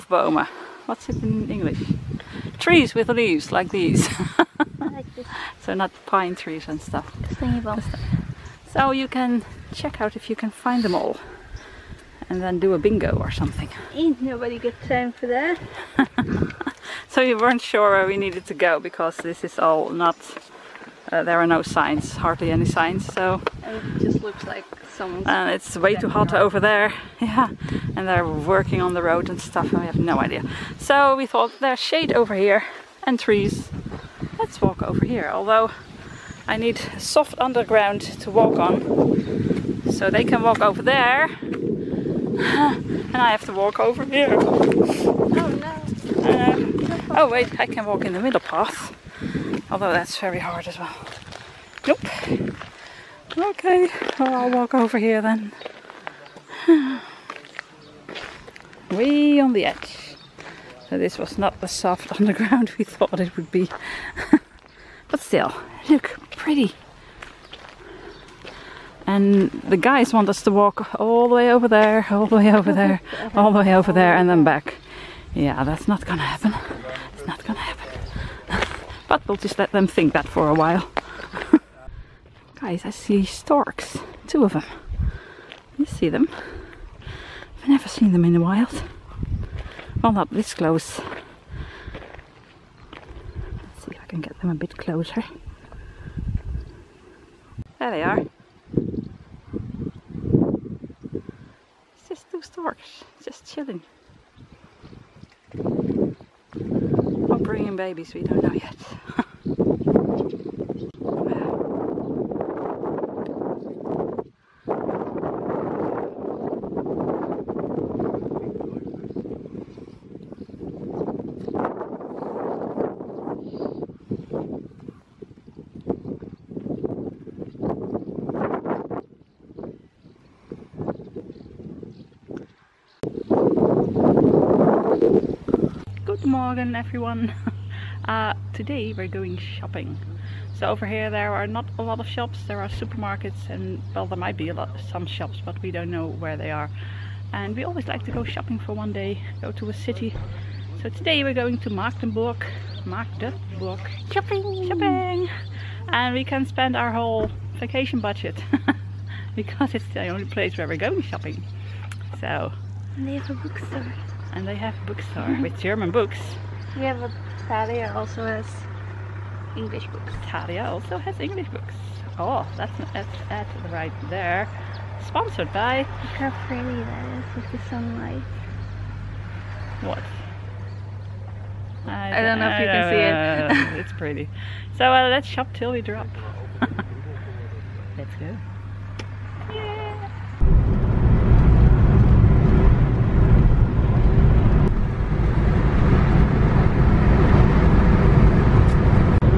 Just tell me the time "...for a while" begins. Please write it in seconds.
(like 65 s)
80 s.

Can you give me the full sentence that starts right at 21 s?
Uh, there are no signs, hardly any signs, so...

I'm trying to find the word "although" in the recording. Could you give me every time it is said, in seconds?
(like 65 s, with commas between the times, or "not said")
35 s, 49 s.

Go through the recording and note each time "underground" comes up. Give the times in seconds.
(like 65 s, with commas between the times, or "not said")
37 s, 62 s.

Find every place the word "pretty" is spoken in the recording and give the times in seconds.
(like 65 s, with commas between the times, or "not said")
66 s, 176 s, 183 s.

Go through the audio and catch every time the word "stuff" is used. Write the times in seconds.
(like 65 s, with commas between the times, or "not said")
6 s, 29 s.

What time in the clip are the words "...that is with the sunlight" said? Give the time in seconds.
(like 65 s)
176 s.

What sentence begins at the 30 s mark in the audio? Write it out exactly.
So we thought there's shade over here and trees.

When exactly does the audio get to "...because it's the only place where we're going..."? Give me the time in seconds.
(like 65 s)
159 s.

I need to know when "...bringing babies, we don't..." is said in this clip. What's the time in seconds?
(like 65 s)
107 s.